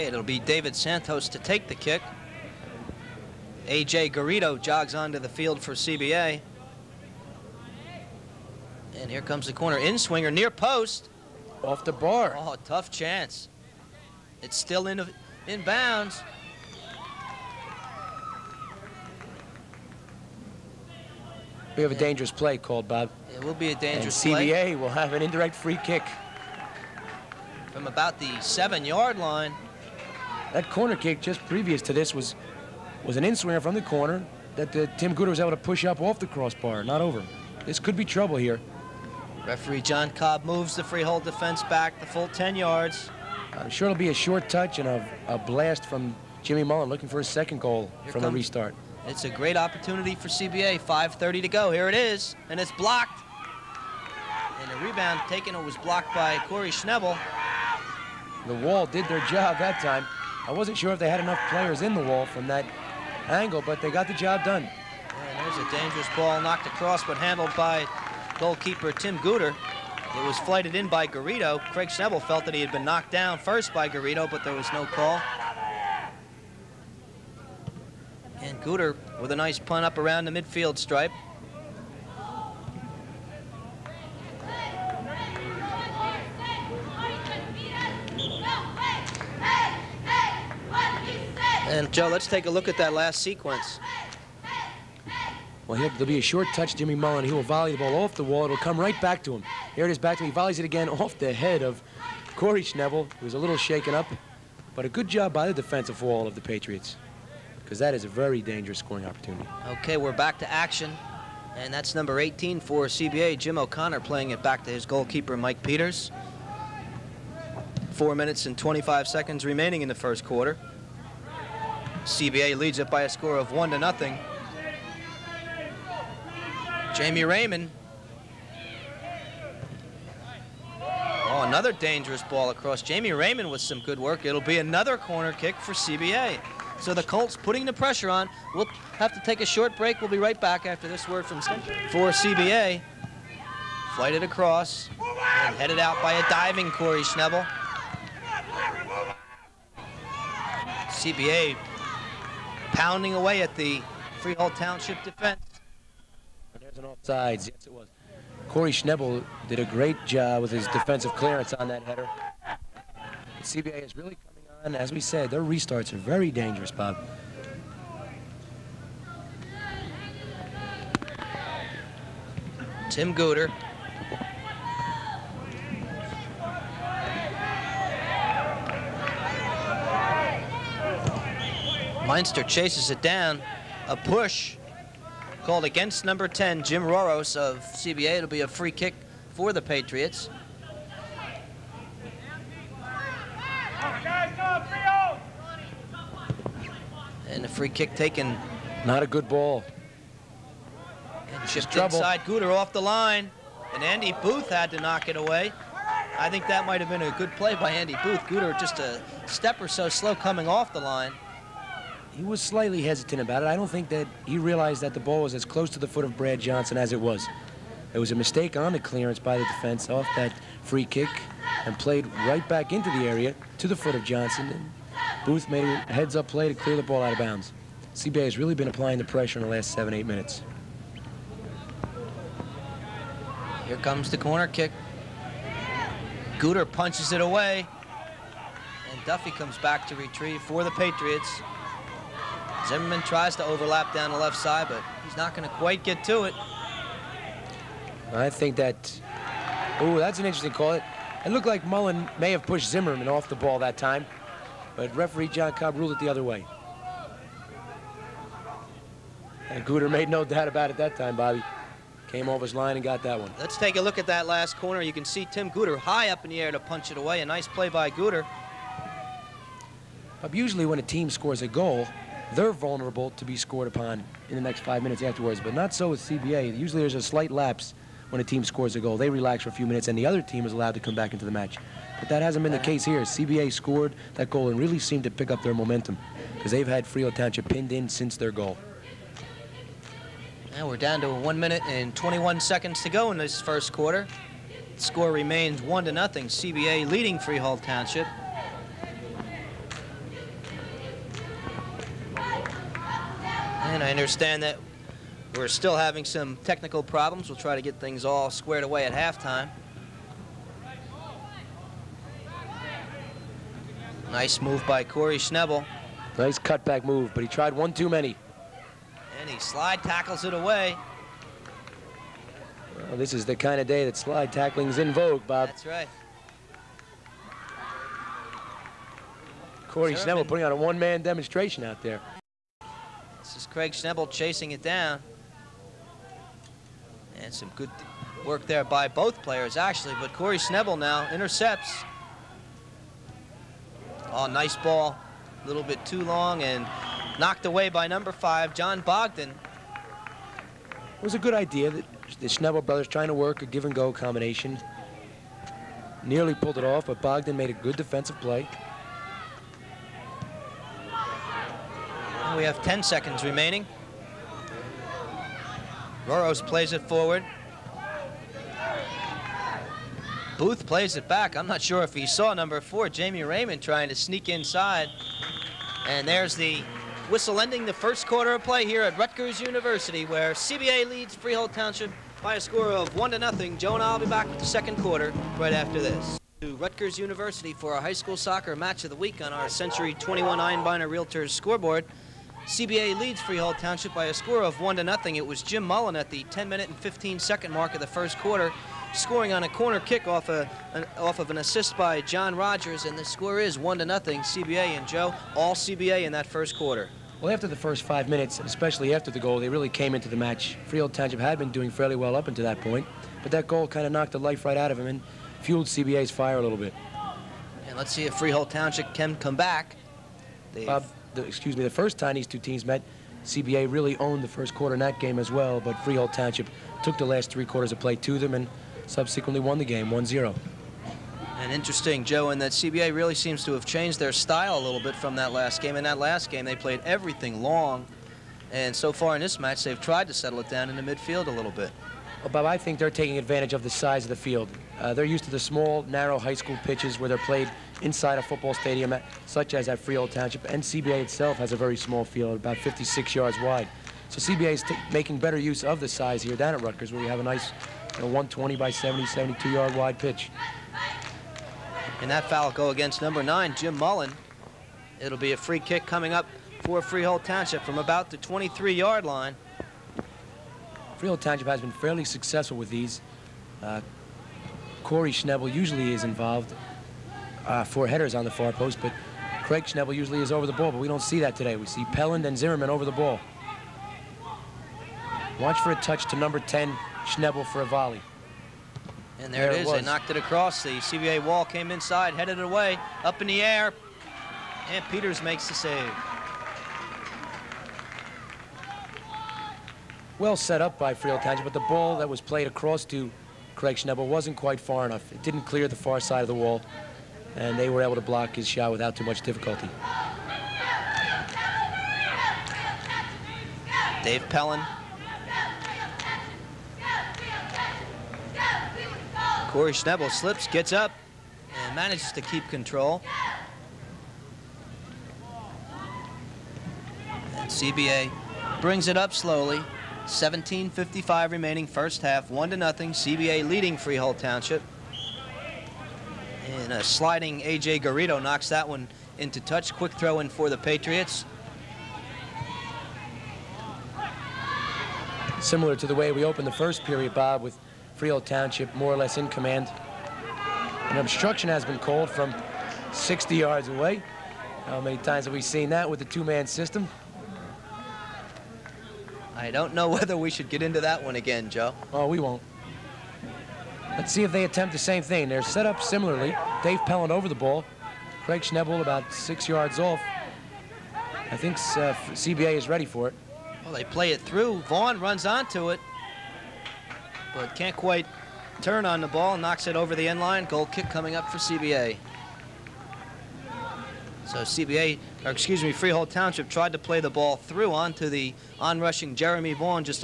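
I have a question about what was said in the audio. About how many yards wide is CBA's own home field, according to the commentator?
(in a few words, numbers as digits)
56 yards.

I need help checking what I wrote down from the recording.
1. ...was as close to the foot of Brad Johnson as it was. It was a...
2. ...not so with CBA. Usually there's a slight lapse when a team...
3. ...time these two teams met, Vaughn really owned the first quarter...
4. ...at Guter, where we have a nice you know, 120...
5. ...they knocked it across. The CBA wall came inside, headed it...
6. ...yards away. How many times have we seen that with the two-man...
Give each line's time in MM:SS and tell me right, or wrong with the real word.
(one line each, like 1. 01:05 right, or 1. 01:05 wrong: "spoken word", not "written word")
1. 03:35 right
2. 04:35 right
3. 07:01 wrong: "CBA", not "Vaughn"
4. 07:36 wrong: "Rutgers", not "Guter"
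5. 08:09 right
6. 09:13 right.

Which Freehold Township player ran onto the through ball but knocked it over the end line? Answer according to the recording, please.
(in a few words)
Jeremy Vaughn.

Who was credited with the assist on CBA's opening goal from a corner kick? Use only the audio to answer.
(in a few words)
John Rogers.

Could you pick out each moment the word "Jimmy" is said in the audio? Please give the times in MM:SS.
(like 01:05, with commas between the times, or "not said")
00:46, 01:36.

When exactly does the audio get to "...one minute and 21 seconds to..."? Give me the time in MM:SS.
04:51.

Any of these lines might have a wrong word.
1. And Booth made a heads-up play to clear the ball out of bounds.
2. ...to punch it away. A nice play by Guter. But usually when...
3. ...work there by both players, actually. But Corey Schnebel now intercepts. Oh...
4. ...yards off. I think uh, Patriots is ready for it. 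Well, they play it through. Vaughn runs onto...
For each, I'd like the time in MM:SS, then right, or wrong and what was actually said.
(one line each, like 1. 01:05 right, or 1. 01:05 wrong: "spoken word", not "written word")
1. 03:44 right
2. 04:26 right
3. 05:38 right
4. 09:29 wrong: "CBA", not "Patriots".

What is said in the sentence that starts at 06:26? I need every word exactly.
To Rutgers University for our high school soccer match of the week on our Century 21 Einbinder Realtors scoreboard.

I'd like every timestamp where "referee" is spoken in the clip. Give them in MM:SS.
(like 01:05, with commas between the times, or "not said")
00:39, 04:14.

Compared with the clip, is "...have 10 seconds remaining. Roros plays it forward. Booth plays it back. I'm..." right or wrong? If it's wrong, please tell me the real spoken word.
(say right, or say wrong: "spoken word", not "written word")
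right.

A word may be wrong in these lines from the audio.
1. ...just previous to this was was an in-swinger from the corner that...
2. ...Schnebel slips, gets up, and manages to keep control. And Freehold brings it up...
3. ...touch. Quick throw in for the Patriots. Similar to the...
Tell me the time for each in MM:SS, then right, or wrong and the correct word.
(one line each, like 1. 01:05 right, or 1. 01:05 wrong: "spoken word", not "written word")
1. 00:31 right
2. 08:39 wrong: "CBA", not "Freehold"
3. 08:59 right.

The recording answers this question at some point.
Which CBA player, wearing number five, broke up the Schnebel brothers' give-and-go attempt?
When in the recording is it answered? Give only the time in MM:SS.
05:48.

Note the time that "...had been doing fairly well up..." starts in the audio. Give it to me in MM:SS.
06:51.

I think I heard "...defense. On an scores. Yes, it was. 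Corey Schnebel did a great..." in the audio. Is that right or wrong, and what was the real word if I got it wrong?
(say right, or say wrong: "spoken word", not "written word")
wrong: "offsides", not "scores".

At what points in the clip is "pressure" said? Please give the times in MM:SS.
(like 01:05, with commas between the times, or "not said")
02:17, 03:49.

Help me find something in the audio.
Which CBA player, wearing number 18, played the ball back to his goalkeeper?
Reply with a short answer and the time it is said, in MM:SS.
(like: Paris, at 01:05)
Jim O'Connor, at 01:53.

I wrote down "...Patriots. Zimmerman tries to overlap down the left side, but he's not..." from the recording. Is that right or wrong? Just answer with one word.
right.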